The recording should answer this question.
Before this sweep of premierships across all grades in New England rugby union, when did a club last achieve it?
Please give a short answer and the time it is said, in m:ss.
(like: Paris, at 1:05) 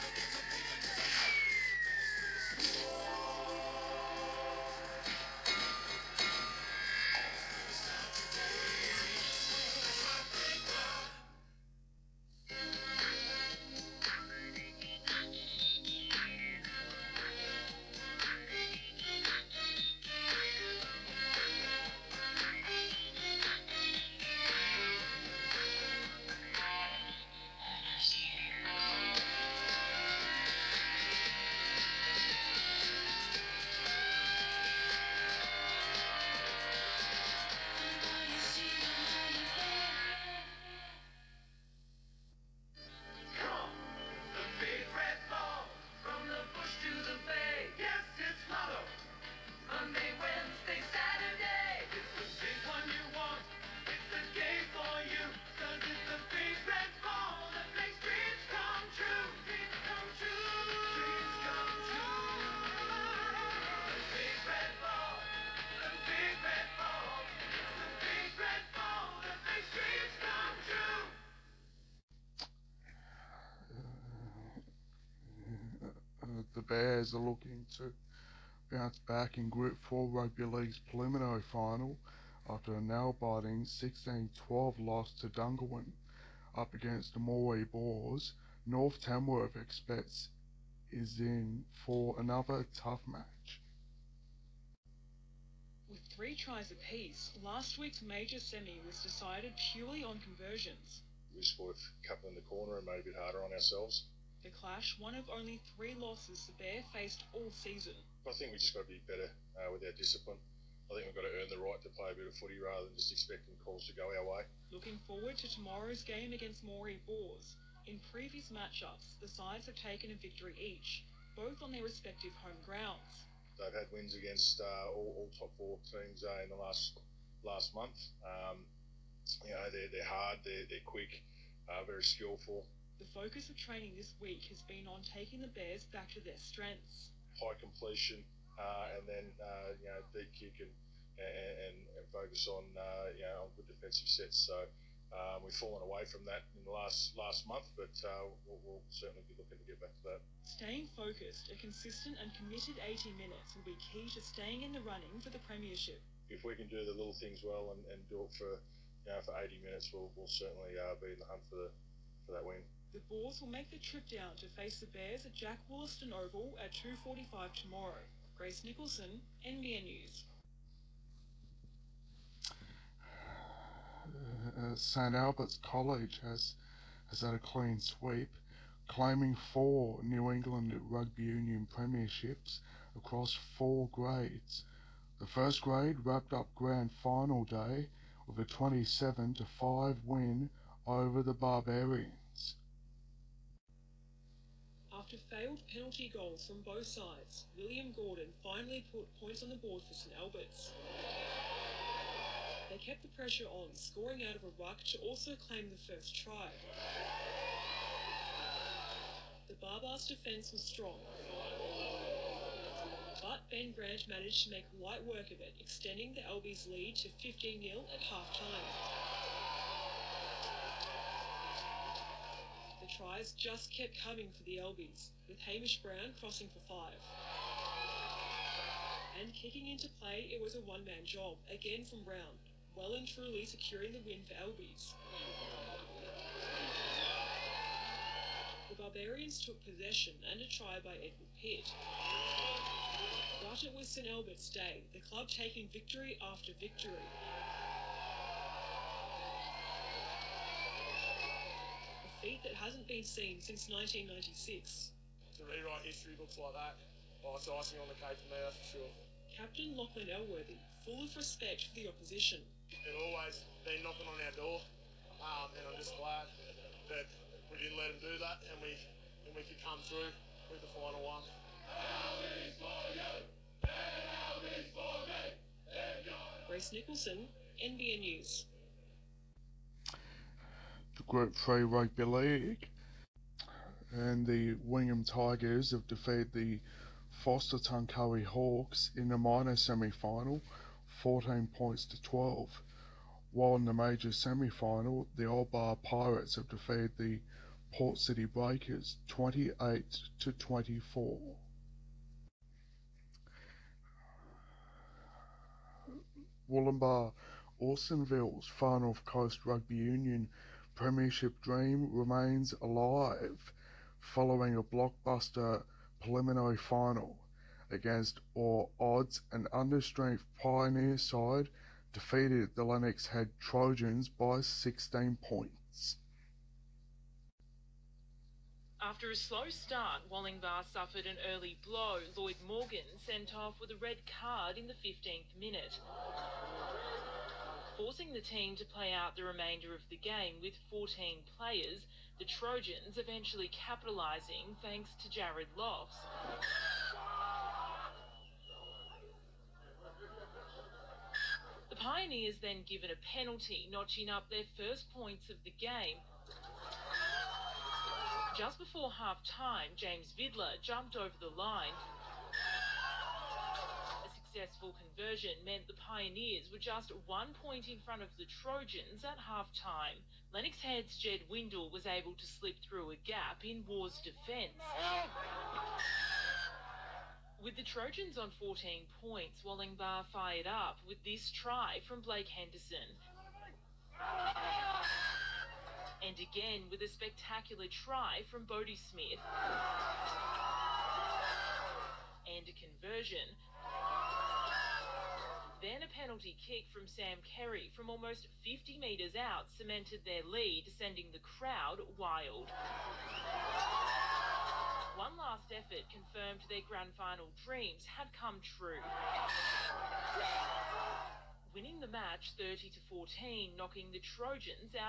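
1996, at 4:13.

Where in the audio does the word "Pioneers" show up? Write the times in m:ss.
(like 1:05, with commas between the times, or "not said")
5:20, 5:51, 6:05.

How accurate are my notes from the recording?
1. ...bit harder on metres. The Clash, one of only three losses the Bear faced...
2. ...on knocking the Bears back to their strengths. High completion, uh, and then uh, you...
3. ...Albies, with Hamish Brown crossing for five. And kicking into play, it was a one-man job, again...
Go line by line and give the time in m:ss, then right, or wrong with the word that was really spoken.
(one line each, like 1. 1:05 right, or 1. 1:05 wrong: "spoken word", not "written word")
1. 1:43 wrong: "ourselves", not "metres"
2. 2:14 wrong: "taking", not "knocking"
3. 3:44 right.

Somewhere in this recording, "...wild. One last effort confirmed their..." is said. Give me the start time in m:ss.
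6:42.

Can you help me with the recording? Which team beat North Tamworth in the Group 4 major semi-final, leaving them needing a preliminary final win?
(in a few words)
Dungowan.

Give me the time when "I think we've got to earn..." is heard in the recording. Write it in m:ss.
1:50.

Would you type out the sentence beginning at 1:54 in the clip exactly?
Looking forward to tomorrow's game against Moree Boars.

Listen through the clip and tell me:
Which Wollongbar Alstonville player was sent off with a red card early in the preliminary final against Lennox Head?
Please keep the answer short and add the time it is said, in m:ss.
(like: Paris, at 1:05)
Lloyd Morgan, at 5:32.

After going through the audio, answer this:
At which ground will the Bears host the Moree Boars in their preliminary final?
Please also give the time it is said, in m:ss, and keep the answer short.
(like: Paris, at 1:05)
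Jack Wollaston Oval, at 2:45.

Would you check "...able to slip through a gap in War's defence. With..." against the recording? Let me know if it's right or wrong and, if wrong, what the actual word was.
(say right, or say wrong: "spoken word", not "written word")
right.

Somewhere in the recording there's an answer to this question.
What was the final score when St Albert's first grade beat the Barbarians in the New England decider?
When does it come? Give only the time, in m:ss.
3:08.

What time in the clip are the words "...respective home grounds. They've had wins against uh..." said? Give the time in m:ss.
2:01.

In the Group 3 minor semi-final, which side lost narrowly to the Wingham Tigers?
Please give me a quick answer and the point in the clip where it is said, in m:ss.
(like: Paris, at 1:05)
Forster Tuncurry Hawks, at 4:47.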